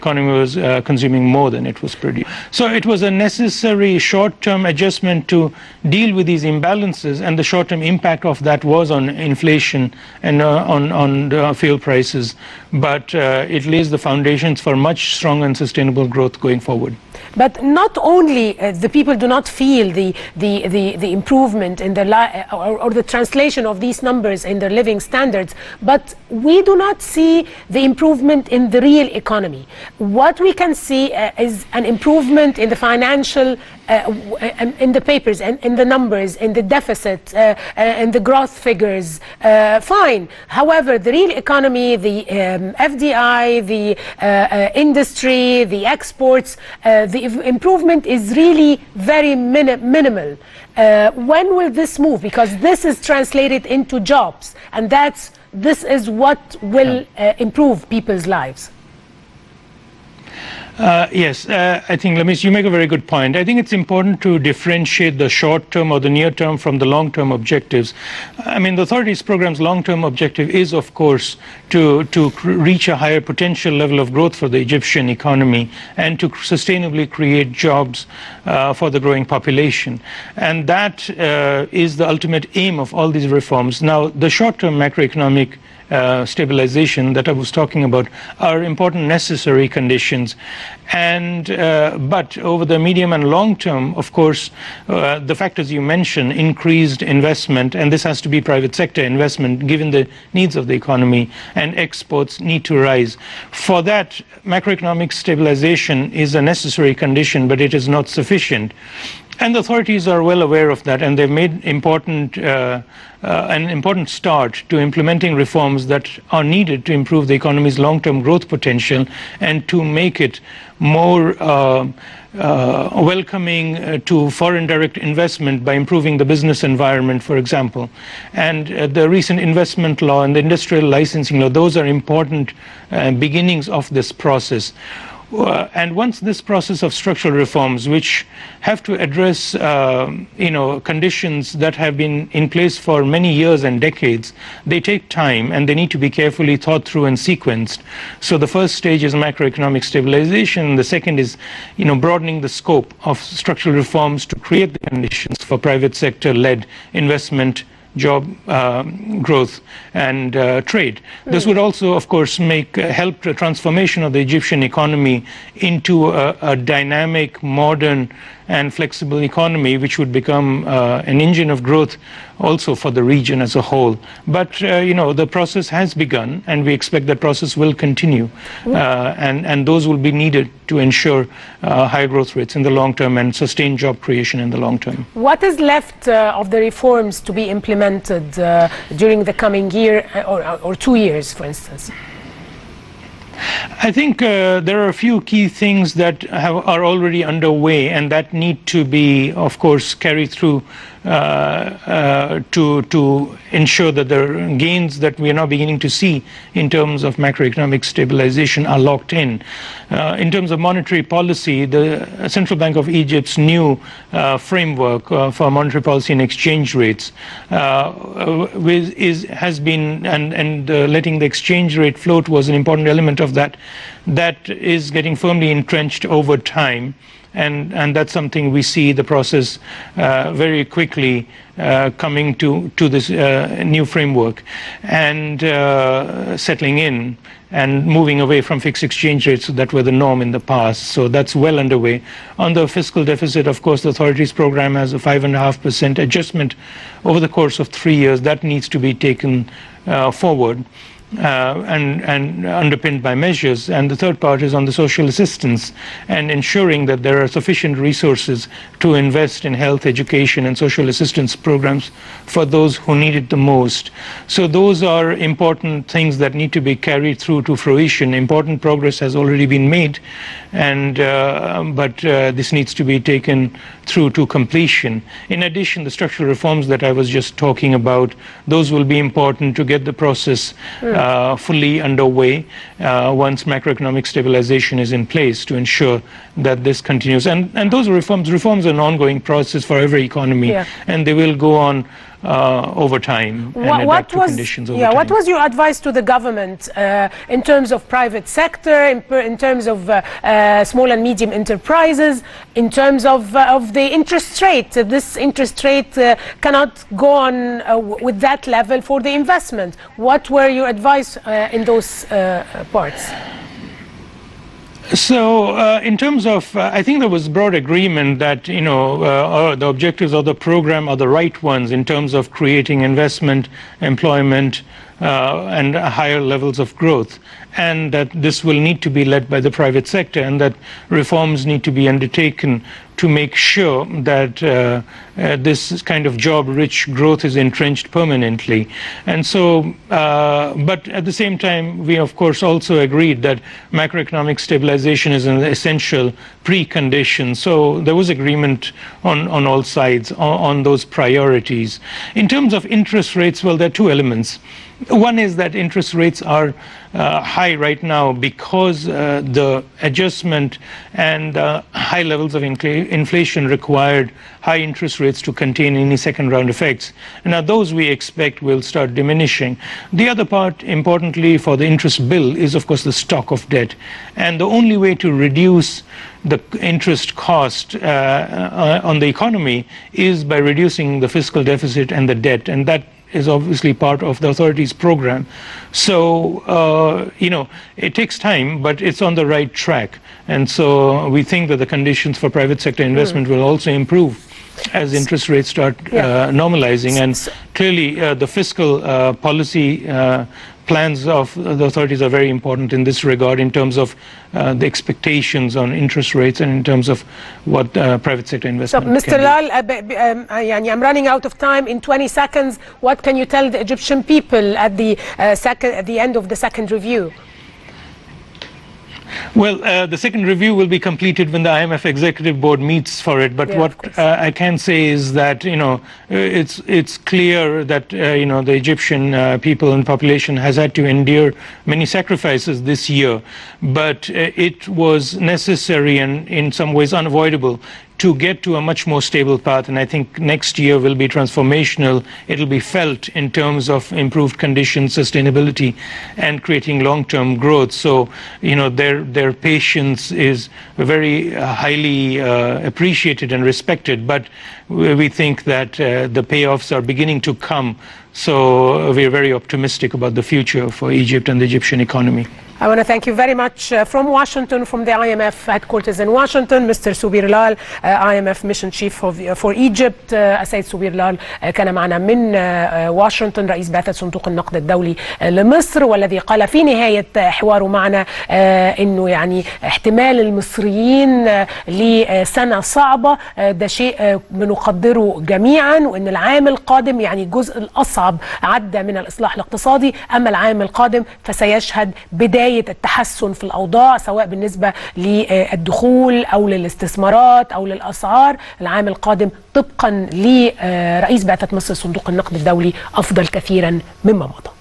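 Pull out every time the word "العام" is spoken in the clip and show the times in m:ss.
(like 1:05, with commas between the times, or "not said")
8:06, 8:10, 8:18.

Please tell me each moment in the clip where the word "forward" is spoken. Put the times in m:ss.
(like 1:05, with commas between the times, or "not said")
0:16, 4:10.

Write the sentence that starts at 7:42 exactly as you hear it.
I want to thank you very much uh, from Washington, from the IMF headquarters in Washington, Mr.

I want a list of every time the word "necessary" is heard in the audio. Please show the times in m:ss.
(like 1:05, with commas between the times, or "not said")
0:03, 1:29, 1:46, 7:15.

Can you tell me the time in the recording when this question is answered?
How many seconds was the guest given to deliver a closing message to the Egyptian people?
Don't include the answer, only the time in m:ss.
6:51.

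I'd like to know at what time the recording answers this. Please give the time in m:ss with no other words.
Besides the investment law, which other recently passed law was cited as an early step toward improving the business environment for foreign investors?
2:10.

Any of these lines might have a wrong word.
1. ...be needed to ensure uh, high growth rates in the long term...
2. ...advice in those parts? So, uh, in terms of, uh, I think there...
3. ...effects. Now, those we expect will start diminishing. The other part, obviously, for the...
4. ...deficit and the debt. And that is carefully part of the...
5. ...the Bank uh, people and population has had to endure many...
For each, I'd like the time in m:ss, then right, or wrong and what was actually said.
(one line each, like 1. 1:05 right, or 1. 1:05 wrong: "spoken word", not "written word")
1. 3:00 right
2. 5:10 right
3. 6:06 wrong: "importantly", not "obviously"
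4. 6:21 wrong: "obviously", not "carefully"
5. 7:08 wrong: "Egyptian", not "Bank".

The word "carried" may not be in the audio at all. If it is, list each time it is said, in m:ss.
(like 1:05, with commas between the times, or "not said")
3:19, 4:26.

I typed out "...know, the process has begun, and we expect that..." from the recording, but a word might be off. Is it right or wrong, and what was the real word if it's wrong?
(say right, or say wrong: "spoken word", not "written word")
right.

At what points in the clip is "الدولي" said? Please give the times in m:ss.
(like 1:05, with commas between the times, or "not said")
7:54, 8:22.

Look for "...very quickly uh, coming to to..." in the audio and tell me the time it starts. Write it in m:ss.
3:50.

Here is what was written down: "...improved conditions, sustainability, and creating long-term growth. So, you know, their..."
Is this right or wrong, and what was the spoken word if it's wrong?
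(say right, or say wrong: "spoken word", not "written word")
right.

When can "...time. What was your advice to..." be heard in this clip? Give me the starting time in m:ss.
4:54.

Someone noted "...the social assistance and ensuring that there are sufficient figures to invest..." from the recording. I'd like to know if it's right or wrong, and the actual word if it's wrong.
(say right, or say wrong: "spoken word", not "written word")
wrong: "resources", not "figures".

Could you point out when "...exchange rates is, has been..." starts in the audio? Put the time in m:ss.
3:36.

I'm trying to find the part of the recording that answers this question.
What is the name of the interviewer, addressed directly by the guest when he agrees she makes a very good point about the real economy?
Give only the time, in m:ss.
1:02.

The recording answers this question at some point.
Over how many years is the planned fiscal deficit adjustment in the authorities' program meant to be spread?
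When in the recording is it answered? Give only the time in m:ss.
4:07.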